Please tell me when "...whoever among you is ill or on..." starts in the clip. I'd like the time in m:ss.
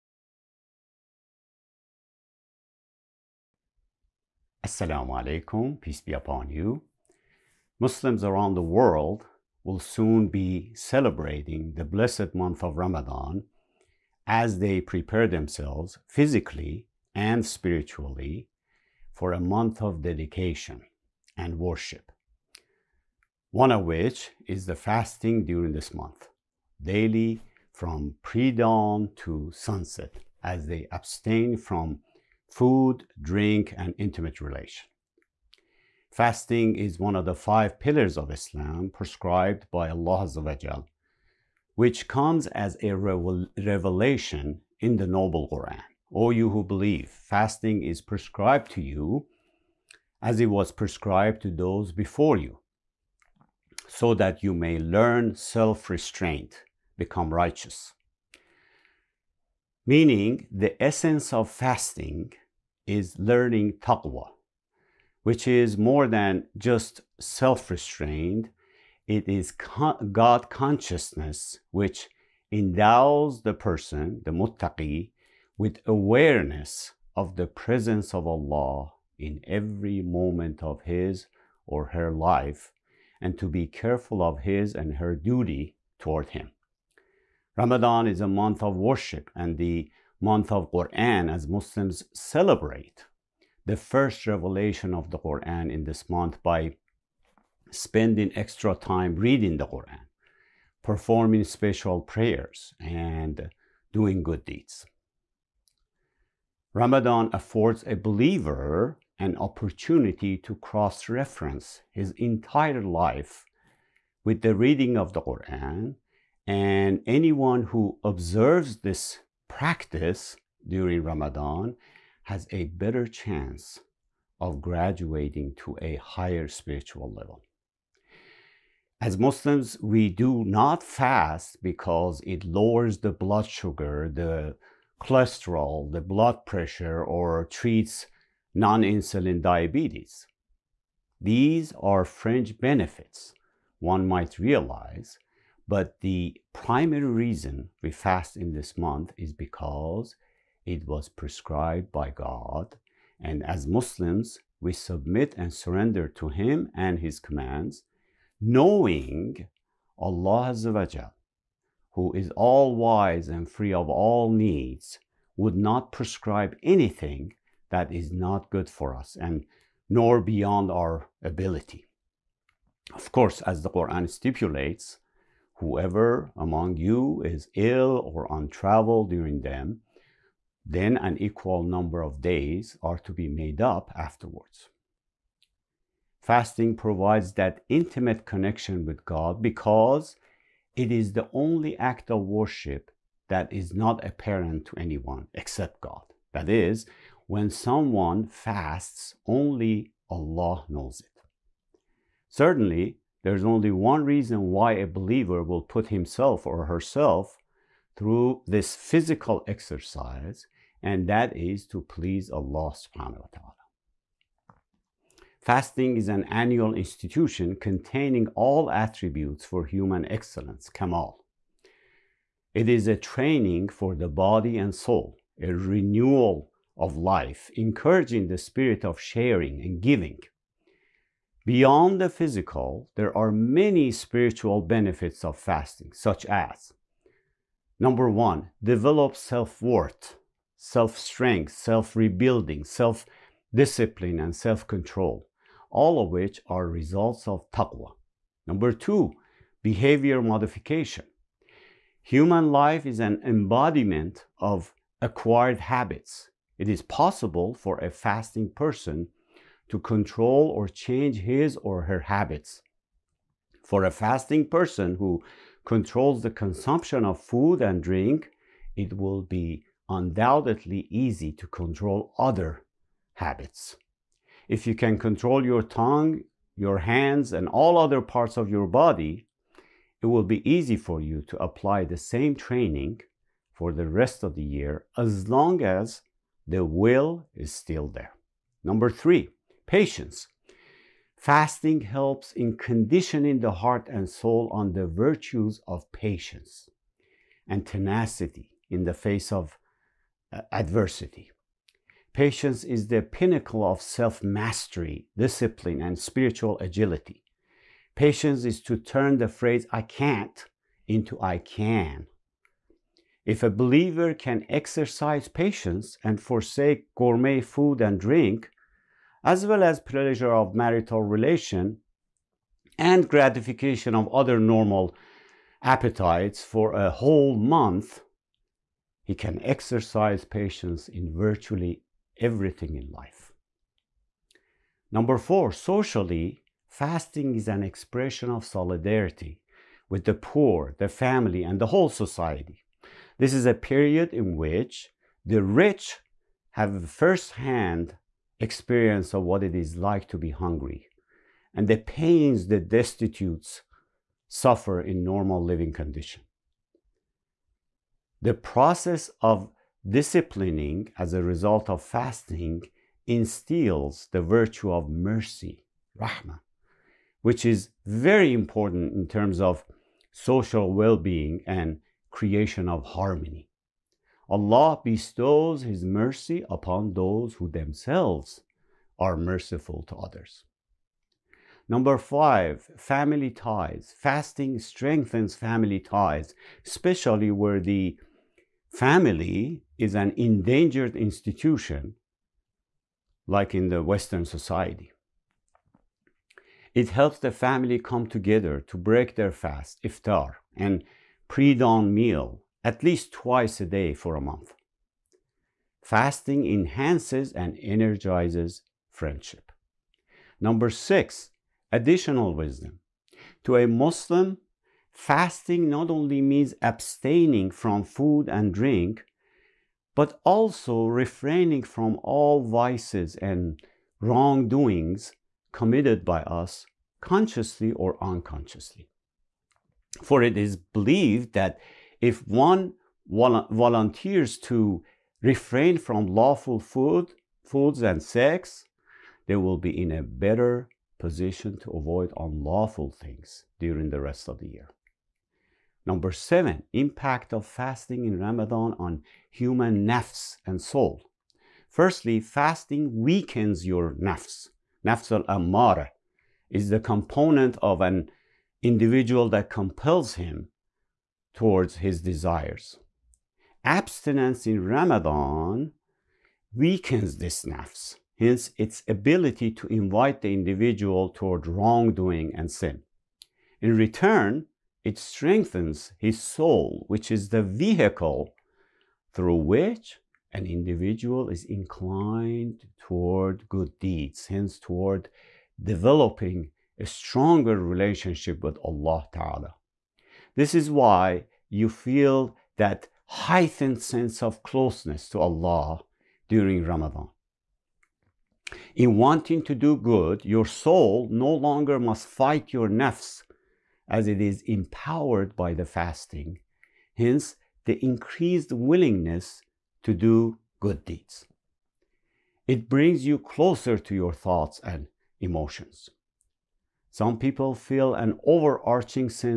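2:55.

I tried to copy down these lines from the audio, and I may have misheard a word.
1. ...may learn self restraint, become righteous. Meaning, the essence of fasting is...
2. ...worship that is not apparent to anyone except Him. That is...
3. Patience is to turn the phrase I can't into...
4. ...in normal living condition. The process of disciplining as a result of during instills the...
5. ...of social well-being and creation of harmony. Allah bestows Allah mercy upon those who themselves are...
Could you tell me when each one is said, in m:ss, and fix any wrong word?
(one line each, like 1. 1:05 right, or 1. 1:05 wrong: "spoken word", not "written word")
1. 0:54 right
2. 3:12 wrong: "God", not "Him"
3. 5:08 right
4. 5:54 wrong: "fasting", not "during"
5. 6:09 wrong: "His", not "Allah".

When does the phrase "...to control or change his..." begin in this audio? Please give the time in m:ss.
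4:19.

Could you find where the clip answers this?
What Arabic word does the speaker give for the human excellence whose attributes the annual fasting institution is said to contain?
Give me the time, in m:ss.
3:40.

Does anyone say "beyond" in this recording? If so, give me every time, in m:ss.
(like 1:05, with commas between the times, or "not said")
2:50, 3:51.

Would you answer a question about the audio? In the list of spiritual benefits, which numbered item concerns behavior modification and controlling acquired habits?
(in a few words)
Number two.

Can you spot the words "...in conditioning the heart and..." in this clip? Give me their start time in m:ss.
4:52.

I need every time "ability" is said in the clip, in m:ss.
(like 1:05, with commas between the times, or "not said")
2:51, 7:48.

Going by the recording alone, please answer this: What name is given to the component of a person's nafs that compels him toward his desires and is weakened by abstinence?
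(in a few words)
Nafs al amara.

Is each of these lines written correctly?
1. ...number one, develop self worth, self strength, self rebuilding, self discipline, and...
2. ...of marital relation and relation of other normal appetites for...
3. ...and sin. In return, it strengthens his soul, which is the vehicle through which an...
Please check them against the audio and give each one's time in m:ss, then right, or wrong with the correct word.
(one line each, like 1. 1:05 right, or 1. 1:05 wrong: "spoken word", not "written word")
1. 3:57 right
2. 5:20 wrong: "gratification", not "relation"
3. 7:52 right.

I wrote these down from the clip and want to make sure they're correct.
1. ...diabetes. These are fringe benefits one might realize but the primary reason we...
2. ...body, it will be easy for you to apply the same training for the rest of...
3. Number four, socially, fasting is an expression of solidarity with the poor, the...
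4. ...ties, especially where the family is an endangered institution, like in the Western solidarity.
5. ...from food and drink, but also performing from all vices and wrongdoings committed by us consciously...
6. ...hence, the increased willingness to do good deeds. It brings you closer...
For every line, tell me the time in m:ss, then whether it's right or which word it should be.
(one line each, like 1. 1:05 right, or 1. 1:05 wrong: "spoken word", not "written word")
1. 2:19 right
2. 4:38 right
3. 5:34 right
4. 6:25 wrong: "society", not "solidarity"
5. 6:57 wrong: "refraining", not "performing"
6. 8:26 right.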